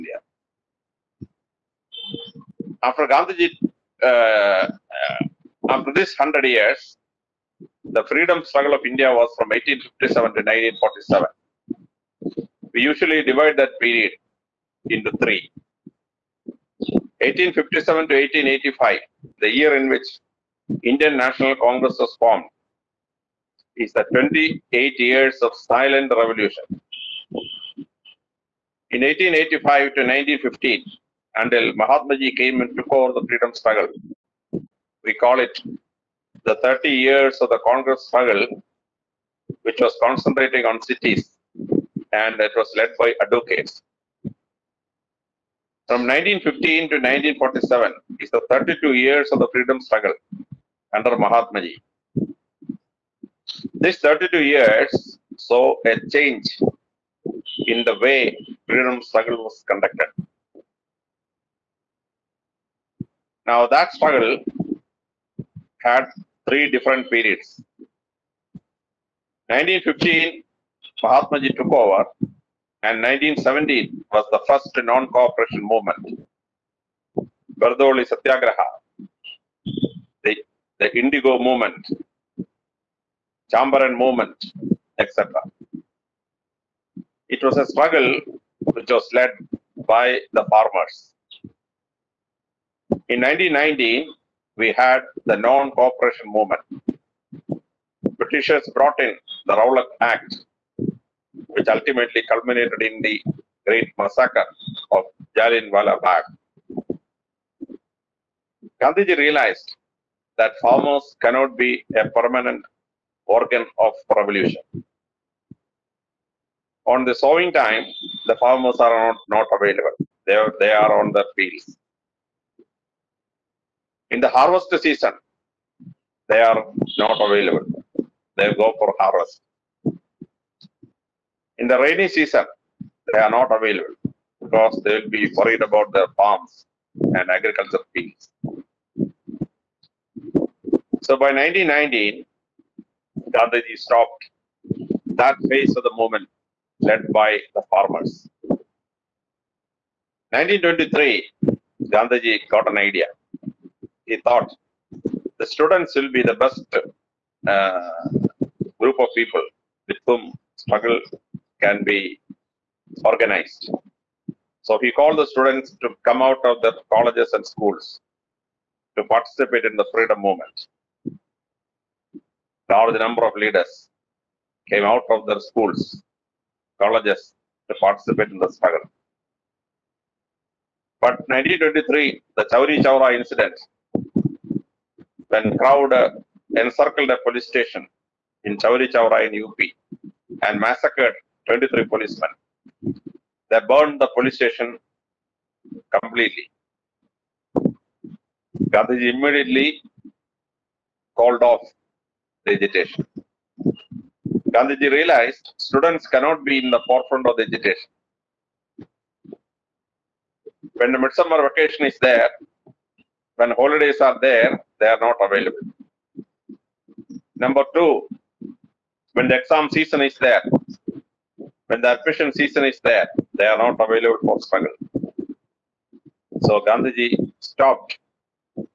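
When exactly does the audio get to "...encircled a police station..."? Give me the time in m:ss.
3:06.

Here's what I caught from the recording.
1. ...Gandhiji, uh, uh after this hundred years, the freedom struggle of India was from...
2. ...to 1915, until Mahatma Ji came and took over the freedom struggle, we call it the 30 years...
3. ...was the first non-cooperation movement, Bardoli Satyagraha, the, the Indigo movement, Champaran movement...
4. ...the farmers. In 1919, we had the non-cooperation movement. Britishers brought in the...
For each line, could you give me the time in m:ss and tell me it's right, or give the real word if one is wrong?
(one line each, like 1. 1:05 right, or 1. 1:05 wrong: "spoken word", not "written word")
1. 0:03 right
2. 0:29 right
3. 1:14 right
4. 1:30 right.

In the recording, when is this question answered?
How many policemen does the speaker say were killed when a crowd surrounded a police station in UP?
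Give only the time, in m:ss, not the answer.
3:11.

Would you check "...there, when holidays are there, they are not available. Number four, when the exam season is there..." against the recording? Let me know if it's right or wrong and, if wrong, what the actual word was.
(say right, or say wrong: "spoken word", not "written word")
wrong: "two", not "four".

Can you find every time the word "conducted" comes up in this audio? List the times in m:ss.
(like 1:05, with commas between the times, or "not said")
0:59.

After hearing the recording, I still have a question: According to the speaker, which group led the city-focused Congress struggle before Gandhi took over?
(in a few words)
advocates.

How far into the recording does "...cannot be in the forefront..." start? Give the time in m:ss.
3:26.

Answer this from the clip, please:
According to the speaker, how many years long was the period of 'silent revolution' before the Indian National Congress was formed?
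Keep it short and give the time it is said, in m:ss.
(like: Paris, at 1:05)
28, at 0:24.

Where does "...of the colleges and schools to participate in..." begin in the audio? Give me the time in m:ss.
2:46.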